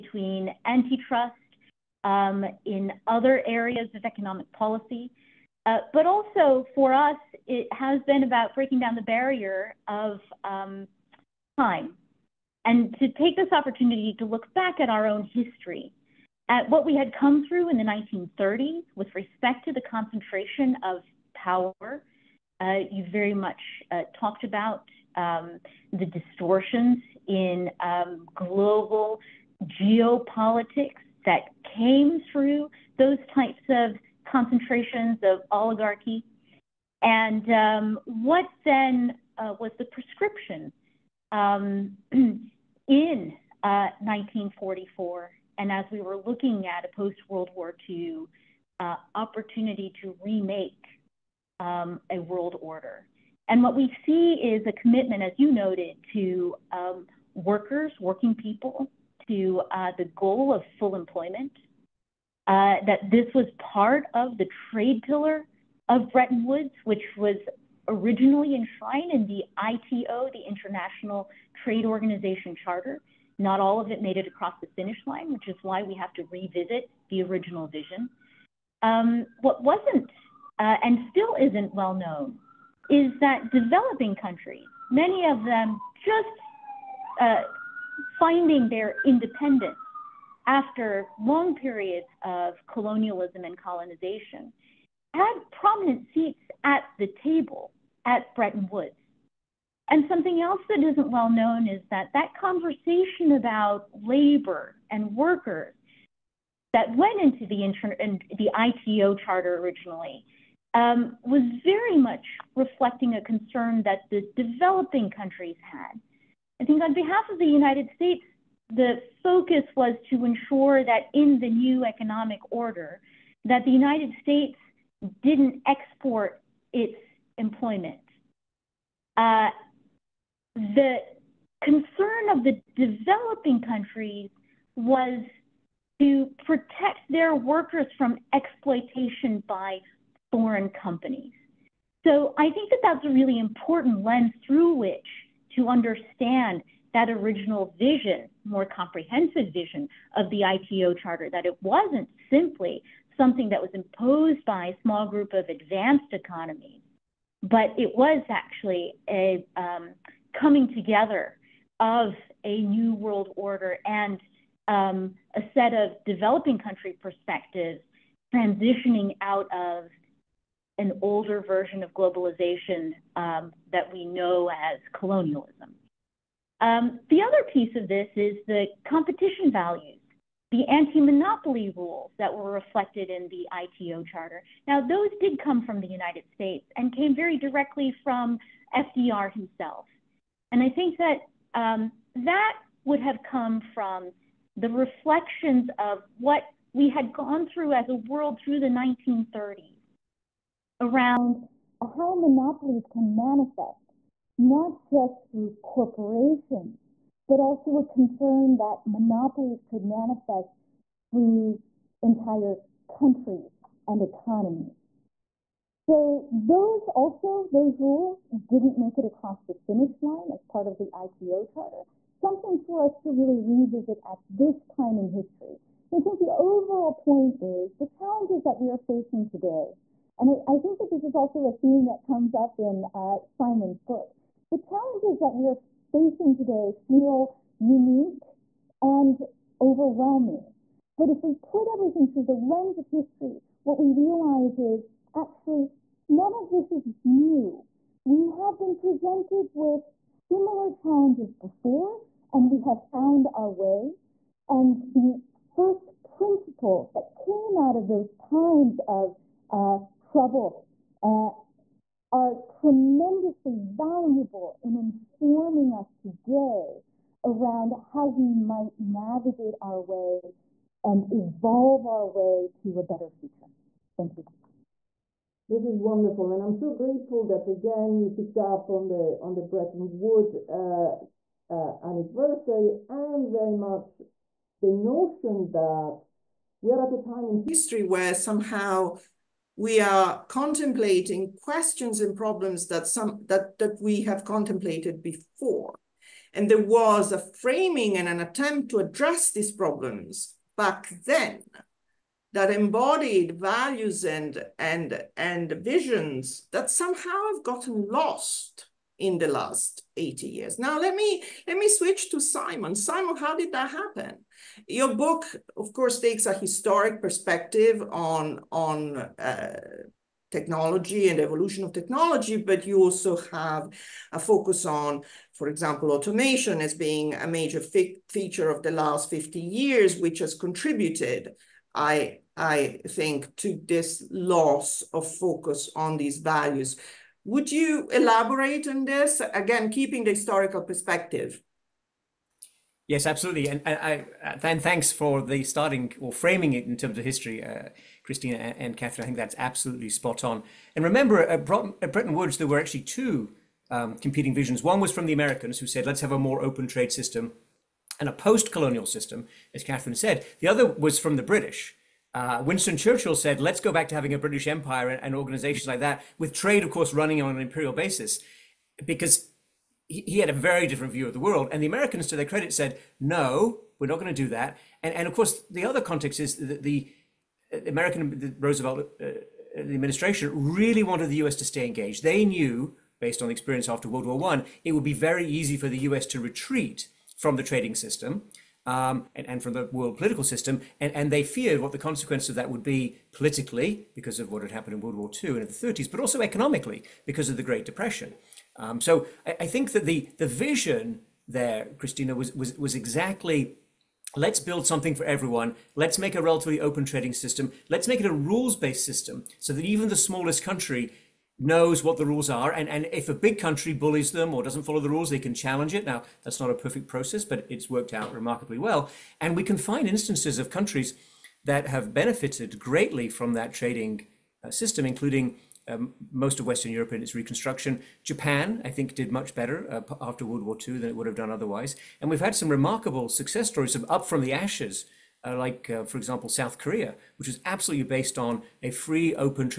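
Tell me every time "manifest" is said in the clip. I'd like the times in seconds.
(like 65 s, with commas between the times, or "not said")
203 s, 209 s.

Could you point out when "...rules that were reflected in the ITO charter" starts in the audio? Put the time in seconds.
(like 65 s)
181 s.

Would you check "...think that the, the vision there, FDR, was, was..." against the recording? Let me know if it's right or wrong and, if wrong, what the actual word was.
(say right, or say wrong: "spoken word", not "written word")
wrong: "Cristina", not "FDR".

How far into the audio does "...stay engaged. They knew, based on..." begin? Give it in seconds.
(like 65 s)
381 s.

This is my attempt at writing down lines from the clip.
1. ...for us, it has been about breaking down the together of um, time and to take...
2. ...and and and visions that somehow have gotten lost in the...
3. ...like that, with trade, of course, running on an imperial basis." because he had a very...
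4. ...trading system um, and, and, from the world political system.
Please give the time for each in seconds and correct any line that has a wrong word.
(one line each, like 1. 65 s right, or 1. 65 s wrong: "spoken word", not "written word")
1. 6 s wrong: "barrier", not "together"
2. 304 s right
3. 365 s right
4. 387 s right.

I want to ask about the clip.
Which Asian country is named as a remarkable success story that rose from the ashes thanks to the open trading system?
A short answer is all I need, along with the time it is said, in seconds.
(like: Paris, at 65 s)
South Korea, at 436 s.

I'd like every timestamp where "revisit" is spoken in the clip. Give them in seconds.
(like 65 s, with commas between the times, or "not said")
76 s, 223 s.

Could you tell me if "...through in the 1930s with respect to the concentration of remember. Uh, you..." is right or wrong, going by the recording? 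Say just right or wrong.
wrong.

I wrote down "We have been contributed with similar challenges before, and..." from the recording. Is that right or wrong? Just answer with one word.
wrong.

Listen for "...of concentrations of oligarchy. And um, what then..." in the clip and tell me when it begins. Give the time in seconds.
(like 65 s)
33 s.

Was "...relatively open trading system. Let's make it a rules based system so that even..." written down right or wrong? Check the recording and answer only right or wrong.
right.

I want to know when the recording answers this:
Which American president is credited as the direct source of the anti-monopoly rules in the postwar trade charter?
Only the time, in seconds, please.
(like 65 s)
188 s.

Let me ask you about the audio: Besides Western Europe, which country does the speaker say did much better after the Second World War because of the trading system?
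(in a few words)
Japan.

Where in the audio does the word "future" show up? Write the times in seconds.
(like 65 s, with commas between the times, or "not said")
273 s.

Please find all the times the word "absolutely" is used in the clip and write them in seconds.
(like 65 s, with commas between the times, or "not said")
343 s, 349 s, 437 s.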